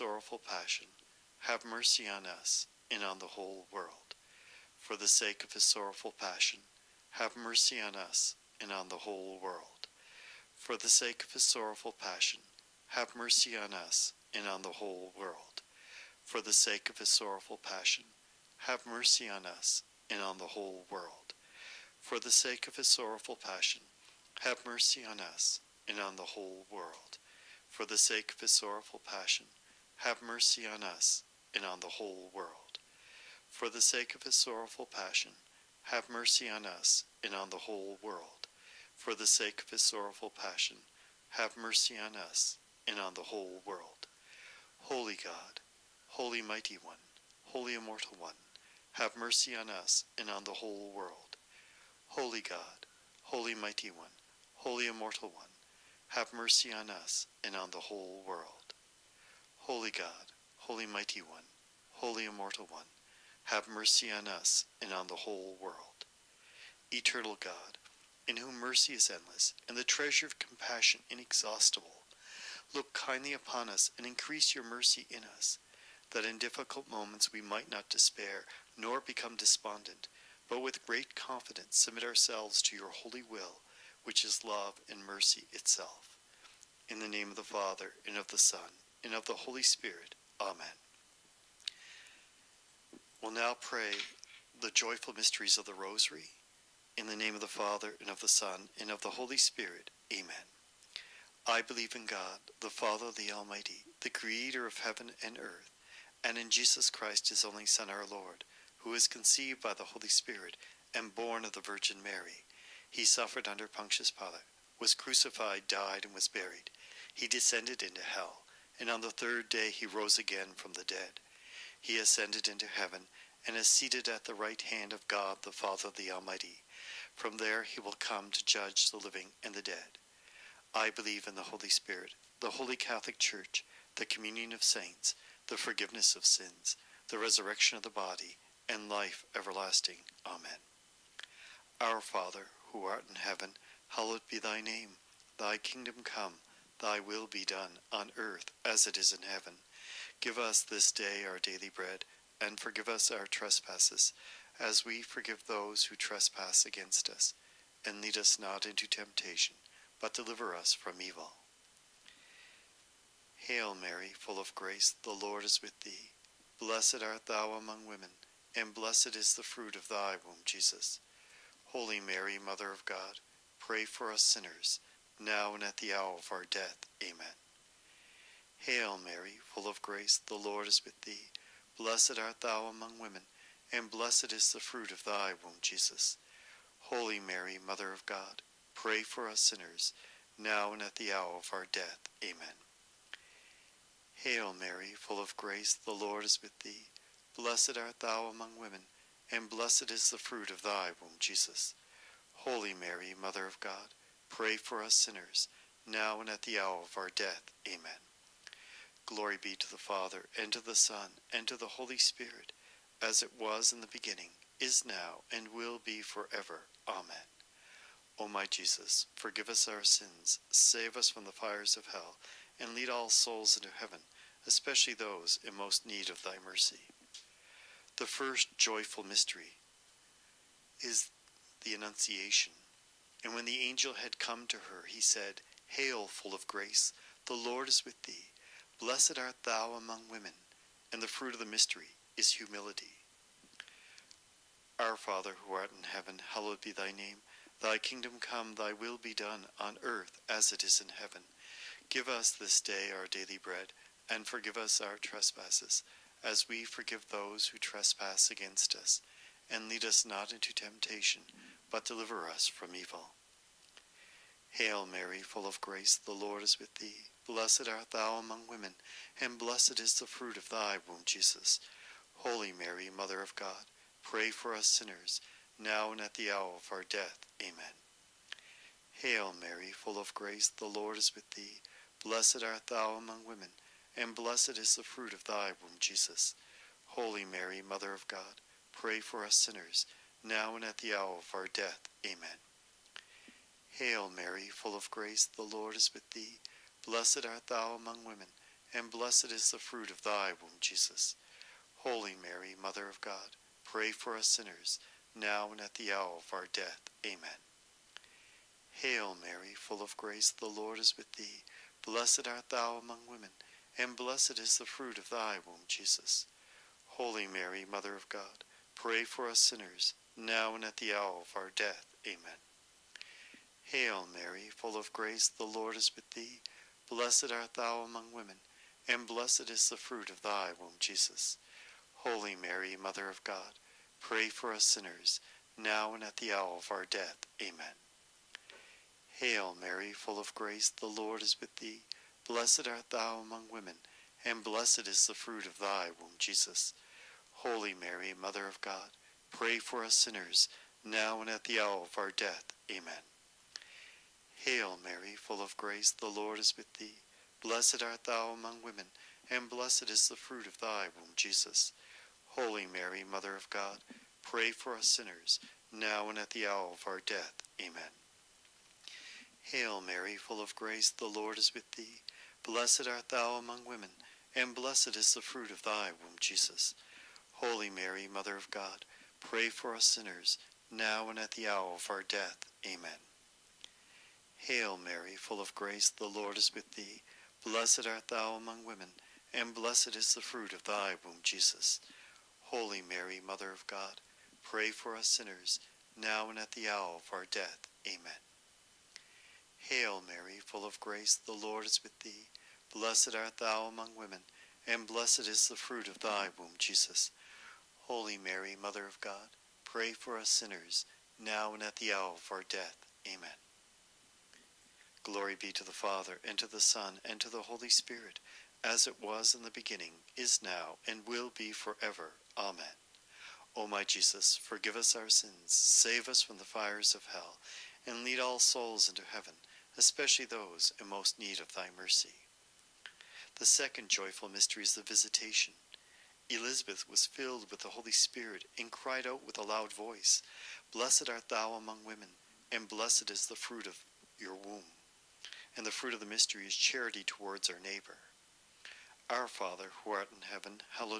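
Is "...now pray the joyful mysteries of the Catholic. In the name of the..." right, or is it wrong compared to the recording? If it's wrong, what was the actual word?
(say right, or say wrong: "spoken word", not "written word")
wrong: "Rosary", not "Catholic".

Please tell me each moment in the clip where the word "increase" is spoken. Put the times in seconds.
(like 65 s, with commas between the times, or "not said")
74 s.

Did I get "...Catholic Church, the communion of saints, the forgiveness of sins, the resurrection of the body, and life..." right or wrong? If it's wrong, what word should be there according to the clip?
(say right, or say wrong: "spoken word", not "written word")
right.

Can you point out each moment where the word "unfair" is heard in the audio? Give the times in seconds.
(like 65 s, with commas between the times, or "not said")
not said.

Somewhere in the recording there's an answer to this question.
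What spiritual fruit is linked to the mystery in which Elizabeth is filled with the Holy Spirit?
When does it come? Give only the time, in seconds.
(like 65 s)
446 s.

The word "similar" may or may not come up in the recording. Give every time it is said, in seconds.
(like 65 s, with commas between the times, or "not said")
not said.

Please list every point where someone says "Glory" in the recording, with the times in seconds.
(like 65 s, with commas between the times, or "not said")
209 s, 415 s.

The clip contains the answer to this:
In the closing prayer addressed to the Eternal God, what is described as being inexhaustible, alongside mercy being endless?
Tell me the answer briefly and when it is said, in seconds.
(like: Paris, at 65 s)
The treasure of compassion, at 69 s.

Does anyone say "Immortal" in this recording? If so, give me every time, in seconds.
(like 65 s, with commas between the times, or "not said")
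47 s, 54 s, 62 s.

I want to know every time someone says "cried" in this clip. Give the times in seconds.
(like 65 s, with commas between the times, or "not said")
438 s.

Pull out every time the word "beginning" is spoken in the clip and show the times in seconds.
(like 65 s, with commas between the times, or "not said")
213 s, 419 s.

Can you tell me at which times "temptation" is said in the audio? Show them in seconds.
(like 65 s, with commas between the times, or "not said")
158 s, 260 s.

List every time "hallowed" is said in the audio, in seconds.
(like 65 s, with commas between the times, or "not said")
143 s, 246 s.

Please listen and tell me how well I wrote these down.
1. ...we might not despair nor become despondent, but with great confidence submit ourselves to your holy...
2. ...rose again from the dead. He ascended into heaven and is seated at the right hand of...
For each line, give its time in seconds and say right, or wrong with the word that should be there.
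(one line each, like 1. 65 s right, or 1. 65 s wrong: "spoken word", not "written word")
1. 77 s right
2. 119 s right.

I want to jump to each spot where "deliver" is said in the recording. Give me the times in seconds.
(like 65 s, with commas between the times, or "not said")
160 s, 261 s.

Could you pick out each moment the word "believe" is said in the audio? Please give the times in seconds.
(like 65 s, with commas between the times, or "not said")
101 s, 130 s.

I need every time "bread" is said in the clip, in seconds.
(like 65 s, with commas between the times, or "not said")
151 s, 253 s.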